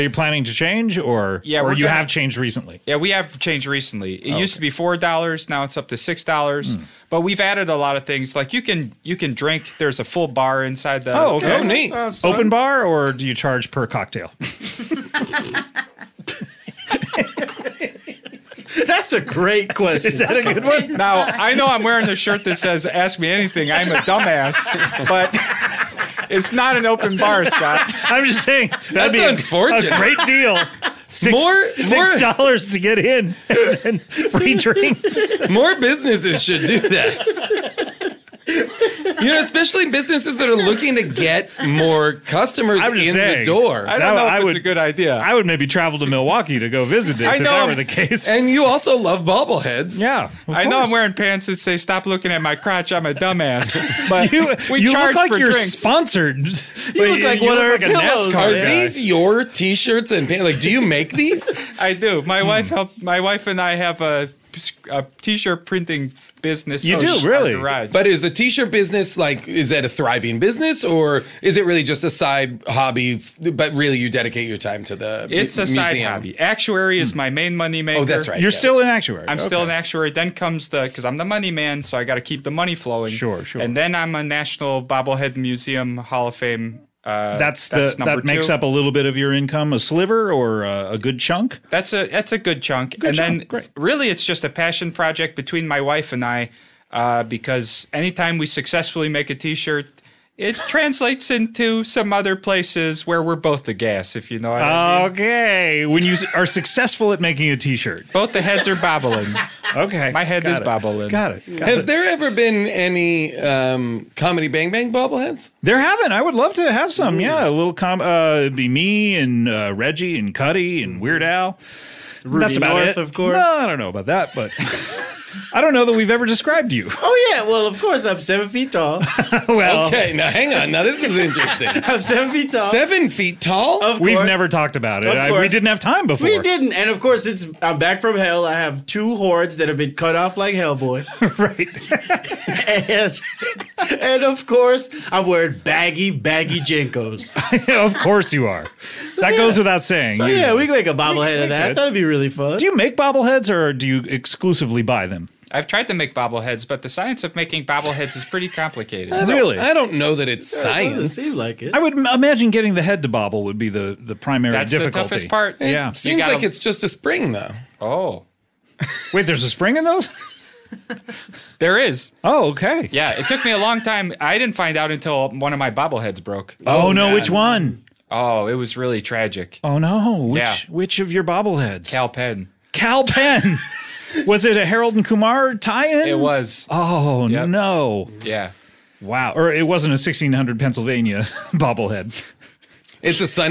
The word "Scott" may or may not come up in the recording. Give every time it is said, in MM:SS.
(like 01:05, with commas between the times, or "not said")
00:27.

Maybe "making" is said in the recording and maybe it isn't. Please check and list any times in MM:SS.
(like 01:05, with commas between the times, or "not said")
01:47, 02:37.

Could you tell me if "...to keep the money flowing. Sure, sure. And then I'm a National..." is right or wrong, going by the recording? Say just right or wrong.
right.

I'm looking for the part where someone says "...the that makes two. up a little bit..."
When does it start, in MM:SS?
01:27.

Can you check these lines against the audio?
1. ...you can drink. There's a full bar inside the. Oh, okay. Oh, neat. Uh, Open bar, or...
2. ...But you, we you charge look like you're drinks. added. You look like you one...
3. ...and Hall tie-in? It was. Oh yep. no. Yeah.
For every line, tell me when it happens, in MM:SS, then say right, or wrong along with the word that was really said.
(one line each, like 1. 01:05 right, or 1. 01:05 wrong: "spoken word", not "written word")
1. 00:09 right
2. 00:54 wrong: "sponsored", not "added"
3. 03:04 wrong: "Kumar", not "Hall".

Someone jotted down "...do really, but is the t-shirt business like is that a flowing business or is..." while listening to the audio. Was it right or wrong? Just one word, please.
wrong.